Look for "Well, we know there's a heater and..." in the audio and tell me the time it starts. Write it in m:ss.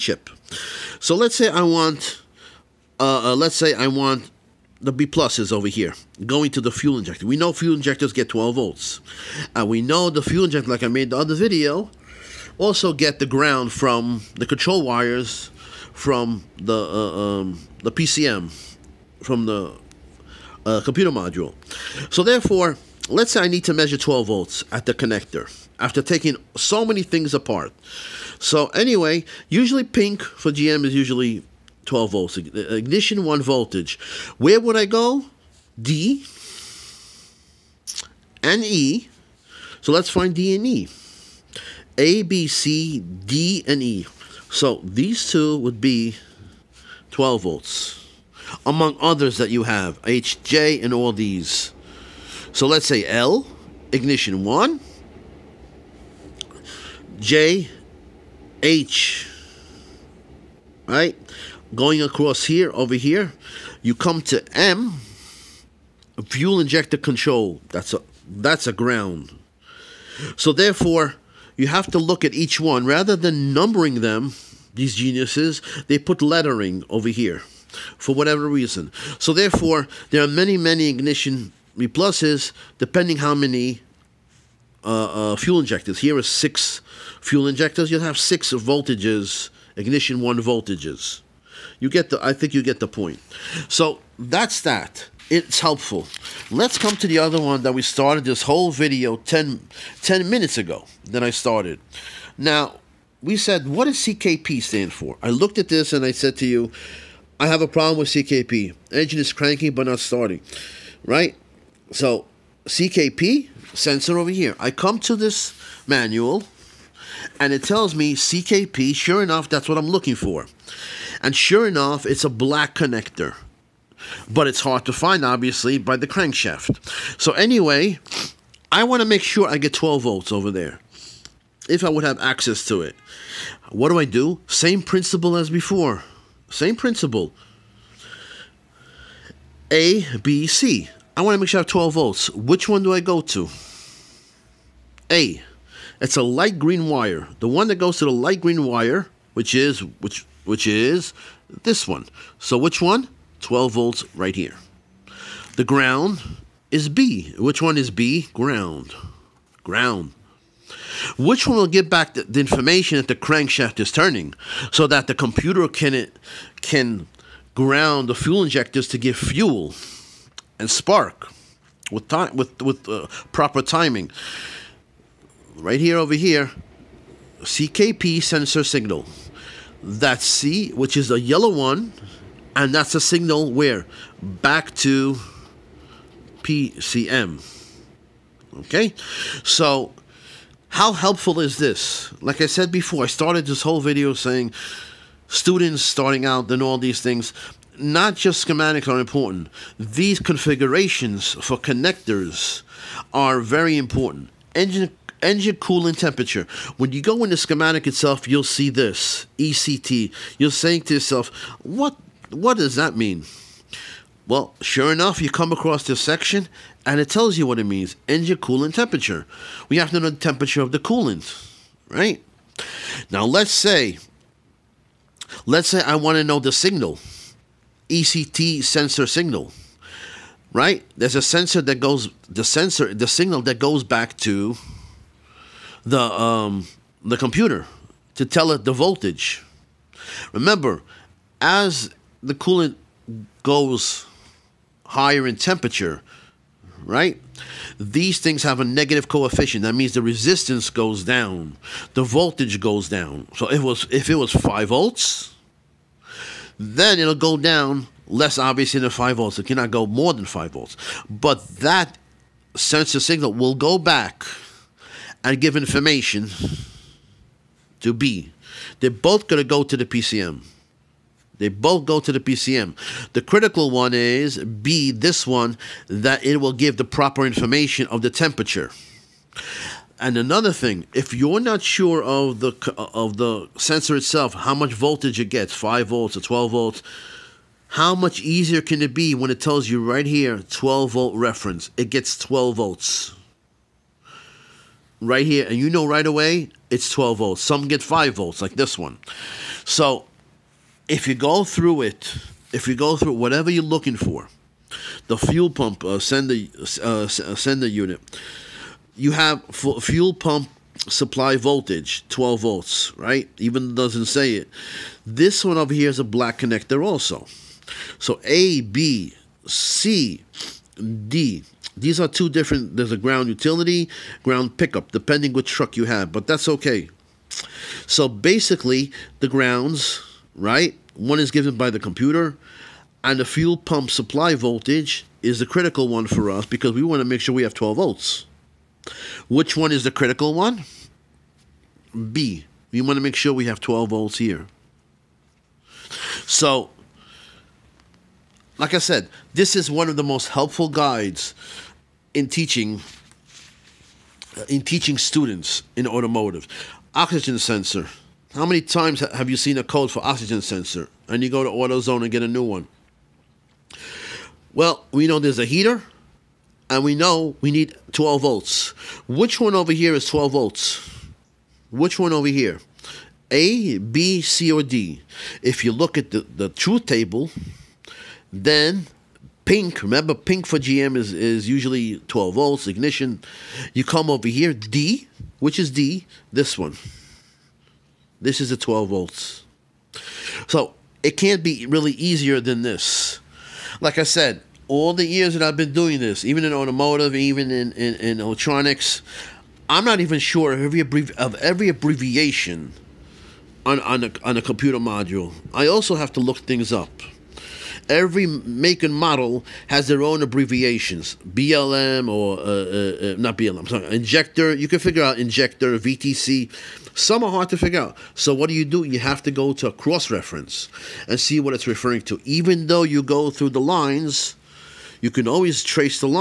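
6:04.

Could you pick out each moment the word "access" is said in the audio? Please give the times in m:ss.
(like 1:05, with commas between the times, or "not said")
2:12.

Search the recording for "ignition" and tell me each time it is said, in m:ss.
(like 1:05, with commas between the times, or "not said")
0:32, 0:53, 1:20, 1:29, 6:22.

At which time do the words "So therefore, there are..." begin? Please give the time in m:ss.
1:19.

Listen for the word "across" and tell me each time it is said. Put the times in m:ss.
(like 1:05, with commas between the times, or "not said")
1:02, 3:35.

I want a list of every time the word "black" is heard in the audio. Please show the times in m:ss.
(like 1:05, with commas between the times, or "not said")
2:02, 5:16.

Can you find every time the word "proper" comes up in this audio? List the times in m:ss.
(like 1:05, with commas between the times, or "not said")
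2:53, 4:36.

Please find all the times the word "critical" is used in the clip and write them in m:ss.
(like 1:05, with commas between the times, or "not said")
4:33, 5:35, 5:39.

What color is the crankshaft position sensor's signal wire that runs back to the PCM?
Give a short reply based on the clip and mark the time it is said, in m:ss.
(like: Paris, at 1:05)
Yellow, at 3:01.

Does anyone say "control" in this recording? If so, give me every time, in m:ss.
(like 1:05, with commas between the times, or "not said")
0:14, 1:06.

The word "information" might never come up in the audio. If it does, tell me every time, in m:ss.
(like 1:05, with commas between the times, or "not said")
2:42, 4:25, 4:37.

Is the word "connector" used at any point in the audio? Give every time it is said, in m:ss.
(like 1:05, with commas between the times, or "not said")
0:24, 2:02, 3:21, 5:16.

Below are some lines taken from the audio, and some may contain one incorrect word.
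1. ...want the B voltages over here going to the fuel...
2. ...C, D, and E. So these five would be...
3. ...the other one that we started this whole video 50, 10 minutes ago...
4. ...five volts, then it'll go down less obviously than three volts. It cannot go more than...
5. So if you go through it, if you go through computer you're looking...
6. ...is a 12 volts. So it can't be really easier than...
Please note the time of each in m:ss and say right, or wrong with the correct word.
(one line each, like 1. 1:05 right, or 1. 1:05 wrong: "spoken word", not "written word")
1. 0:03 wrong: "pluses", not "voltages"
2. 0:42 wrong: "two", not "five"
3. 1:37 wrong: "10", not "50"
4. 4:14 wrong: "five", not "three"
5. 4:59 wrong: "whatever", not "computer"
6. 6:28 right.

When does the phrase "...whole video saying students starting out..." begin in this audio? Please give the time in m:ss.
3:13.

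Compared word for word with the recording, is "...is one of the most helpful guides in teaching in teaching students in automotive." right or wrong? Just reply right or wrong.
right.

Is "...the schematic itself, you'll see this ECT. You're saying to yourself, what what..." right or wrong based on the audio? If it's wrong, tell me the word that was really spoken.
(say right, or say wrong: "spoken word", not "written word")
right.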